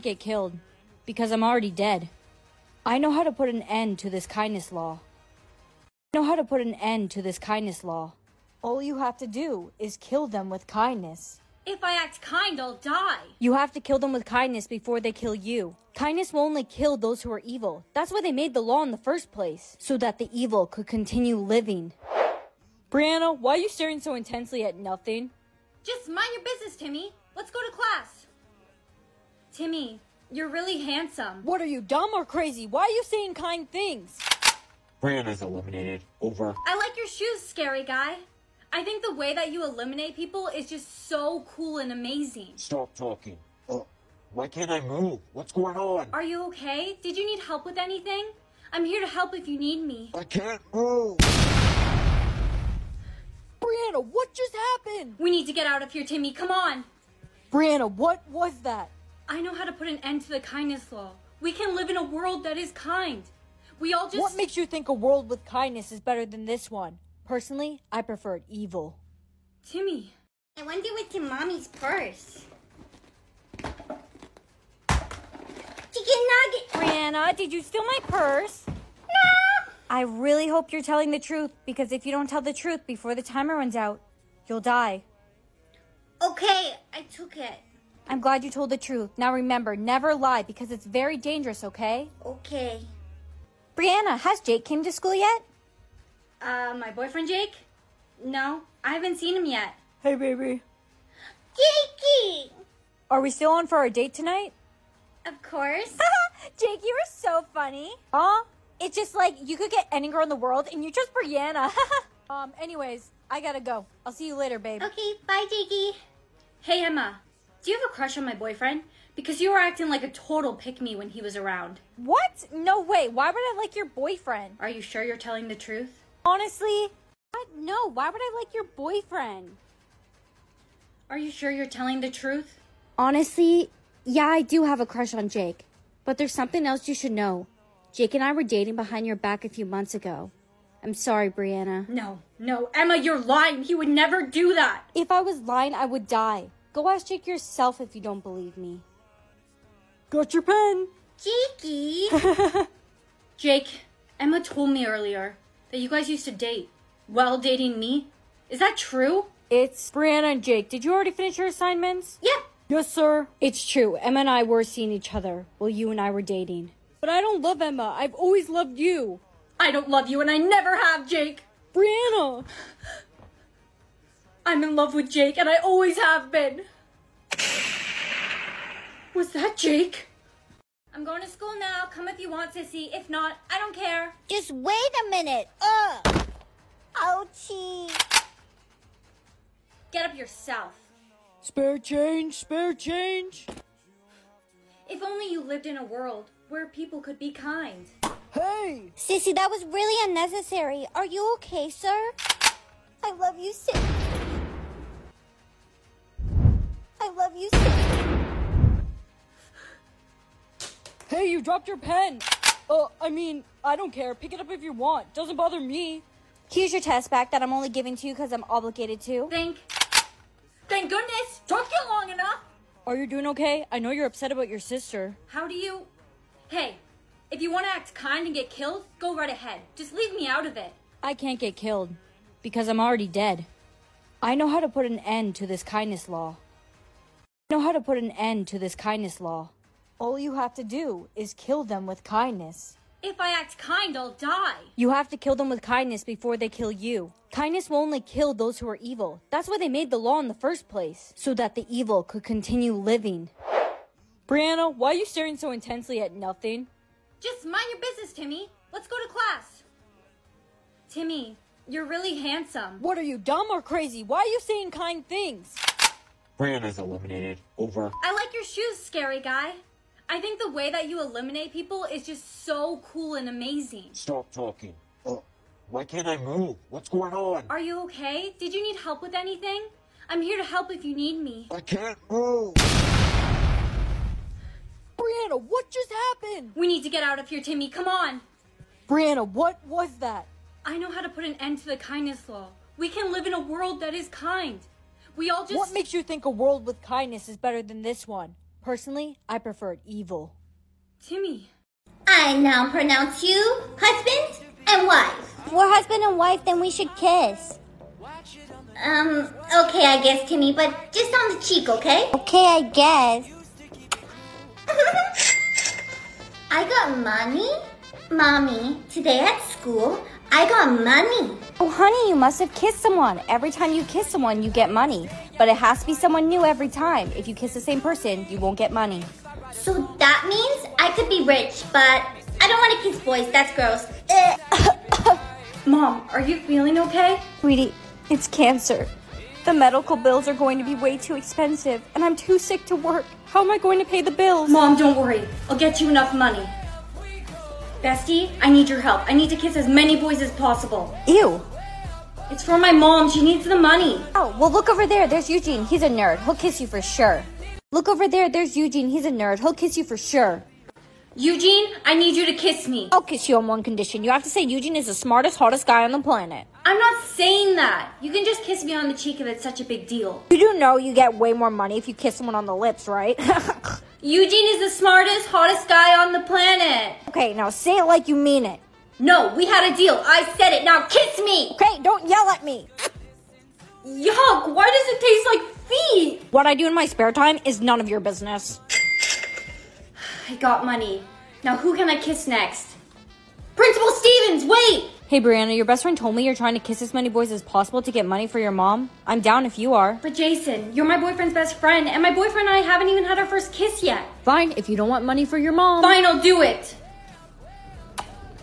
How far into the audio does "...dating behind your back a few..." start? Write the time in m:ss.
2:18.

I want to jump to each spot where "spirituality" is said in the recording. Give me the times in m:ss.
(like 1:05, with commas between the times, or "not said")
not said.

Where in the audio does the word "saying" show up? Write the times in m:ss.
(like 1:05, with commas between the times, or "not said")
0:33, 4:24, 6:07.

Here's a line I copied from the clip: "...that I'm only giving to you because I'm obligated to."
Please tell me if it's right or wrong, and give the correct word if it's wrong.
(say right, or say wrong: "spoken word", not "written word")
right.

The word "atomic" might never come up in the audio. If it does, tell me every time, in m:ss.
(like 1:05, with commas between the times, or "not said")
not said.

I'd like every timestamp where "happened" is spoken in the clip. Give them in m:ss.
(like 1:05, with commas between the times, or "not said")
0:54, 4:45.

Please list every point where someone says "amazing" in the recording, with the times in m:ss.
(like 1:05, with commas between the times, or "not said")
0:41, 4:33.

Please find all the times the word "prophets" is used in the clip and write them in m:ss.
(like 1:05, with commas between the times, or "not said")
not said.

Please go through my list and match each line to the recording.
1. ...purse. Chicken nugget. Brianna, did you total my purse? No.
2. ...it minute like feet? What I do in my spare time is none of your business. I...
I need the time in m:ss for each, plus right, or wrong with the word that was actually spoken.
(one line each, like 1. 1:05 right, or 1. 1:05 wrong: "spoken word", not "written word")
1. 1:11 wrong: "steal", not "total"
2. 6:24 wrong: "taste", not "minute".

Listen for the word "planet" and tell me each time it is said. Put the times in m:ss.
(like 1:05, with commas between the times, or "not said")
6:05, 6:16.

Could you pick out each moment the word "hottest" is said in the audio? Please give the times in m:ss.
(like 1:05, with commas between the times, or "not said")
6:05, 6:15.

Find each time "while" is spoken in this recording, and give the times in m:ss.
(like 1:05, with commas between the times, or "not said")
2:37, 2:45.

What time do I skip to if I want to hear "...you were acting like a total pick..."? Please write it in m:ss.
1:59.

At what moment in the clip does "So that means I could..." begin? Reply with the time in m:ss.
5:29.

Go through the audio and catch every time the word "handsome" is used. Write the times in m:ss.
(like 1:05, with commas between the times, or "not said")
0:30, 4:22.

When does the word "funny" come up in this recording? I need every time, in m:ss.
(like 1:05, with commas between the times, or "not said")
1:47.